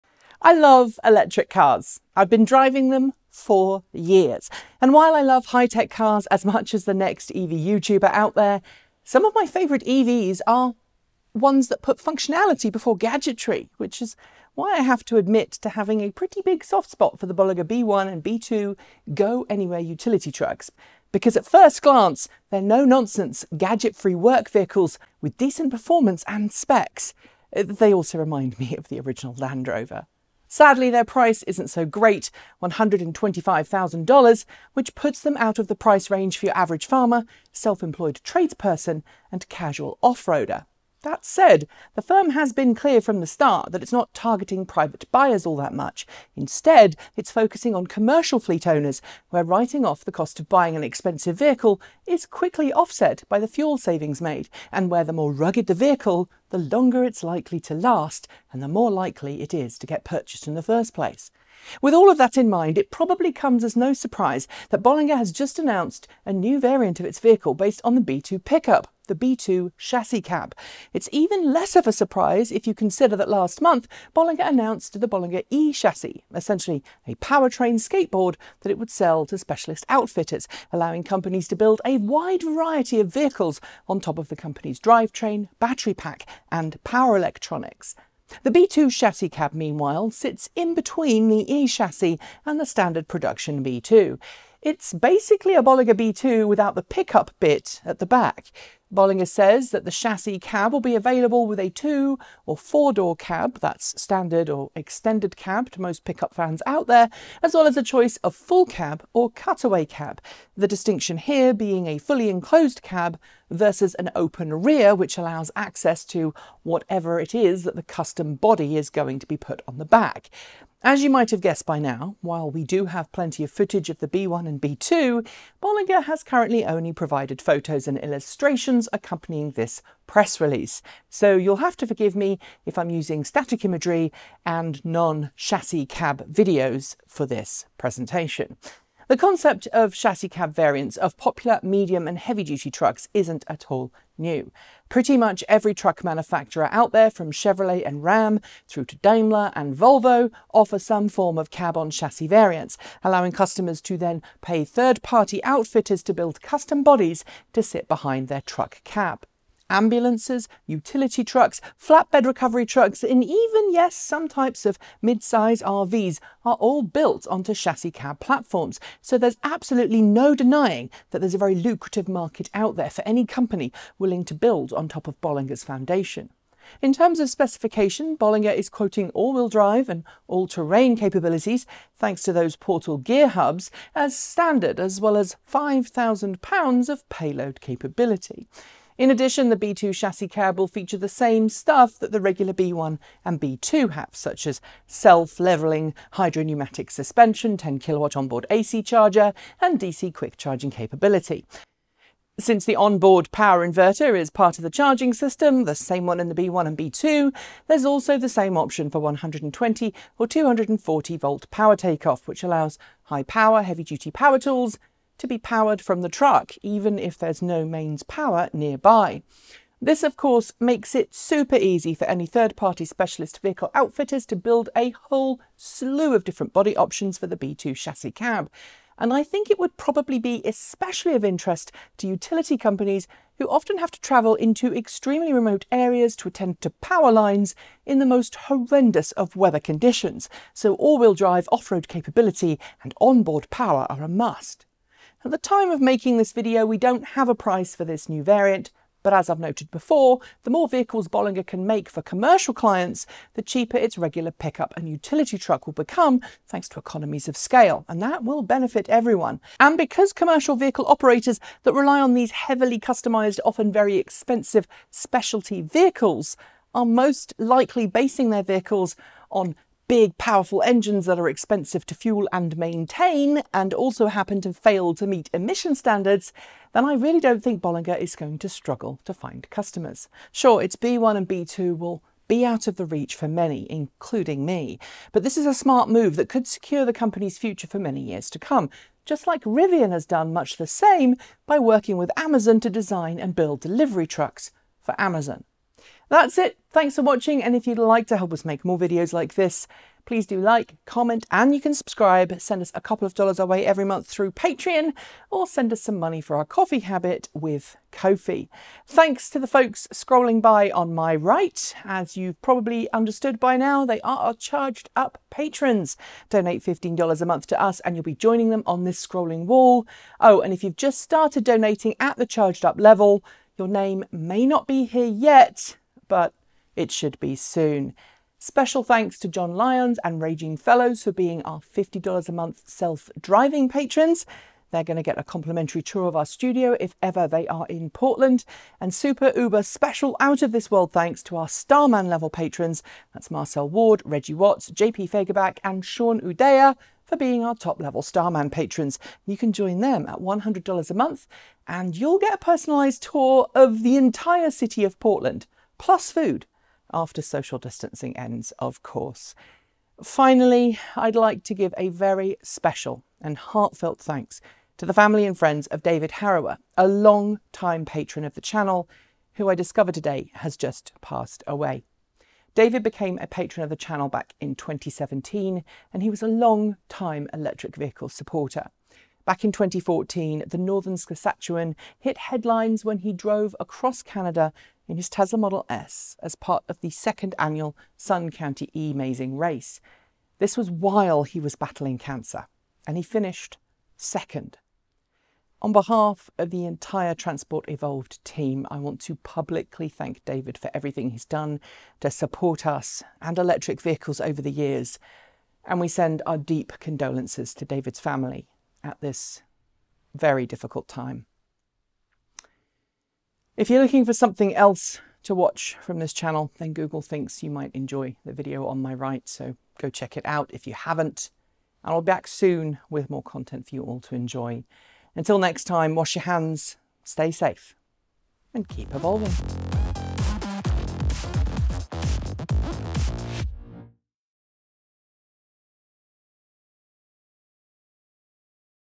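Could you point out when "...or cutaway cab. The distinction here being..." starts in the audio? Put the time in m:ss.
1:49.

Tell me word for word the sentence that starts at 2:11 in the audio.
So you'll have to forgive me if I'm using static imagery and non-chassis cab videos for this presentation.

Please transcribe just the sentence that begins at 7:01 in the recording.
And I'll be back soon with more content for you all to enjoy.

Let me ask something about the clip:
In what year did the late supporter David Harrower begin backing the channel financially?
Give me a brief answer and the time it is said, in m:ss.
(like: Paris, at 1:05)
2017, at 6:14.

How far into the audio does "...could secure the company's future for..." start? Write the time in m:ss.
4:46.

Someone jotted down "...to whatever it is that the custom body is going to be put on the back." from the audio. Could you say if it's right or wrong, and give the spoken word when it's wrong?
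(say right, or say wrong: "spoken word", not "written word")
right.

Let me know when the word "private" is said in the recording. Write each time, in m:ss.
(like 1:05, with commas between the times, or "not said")
0:44.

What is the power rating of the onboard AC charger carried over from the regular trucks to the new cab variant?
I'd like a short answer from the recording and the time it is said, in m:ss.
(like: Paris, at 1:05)
10 kilowatt, at 3:17.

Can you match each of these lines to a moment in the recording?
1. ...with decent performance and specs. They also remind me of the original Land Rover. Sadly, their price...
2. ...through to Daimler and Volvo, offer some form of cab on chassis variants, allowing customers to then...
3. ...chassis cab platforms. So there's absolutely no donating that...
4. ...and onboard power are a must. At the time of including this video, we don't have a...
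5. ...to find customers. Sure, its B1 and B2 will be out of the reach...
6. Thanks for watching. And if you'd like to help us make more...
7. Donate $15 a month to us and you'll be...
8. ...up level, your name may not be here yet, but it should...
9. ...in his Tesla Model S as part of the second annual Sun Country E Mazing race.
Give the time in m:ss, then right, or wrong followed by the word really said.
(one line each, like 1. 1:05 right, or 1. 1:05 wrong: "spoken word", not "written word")
1. 0:25 right
2. 2:28 right
3. 2:47 wrong: "denying", not "donating"
4. 4:02 wrong: "making", not "including"
5. 4:39 right
6. 4:56 right
7. 5:16 right
8. 5:22 right
9. 6:24 right.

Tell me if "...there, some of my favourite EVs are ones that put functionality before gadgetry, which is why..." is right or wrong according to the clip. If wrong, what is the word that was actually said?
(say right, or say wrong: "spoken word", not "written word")
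right.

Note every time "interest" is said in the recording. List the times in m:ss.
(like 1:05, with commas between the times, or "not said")
3:51.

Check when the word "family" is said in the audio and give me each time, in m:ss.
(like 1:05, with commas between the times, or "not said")
6:04, 6:48.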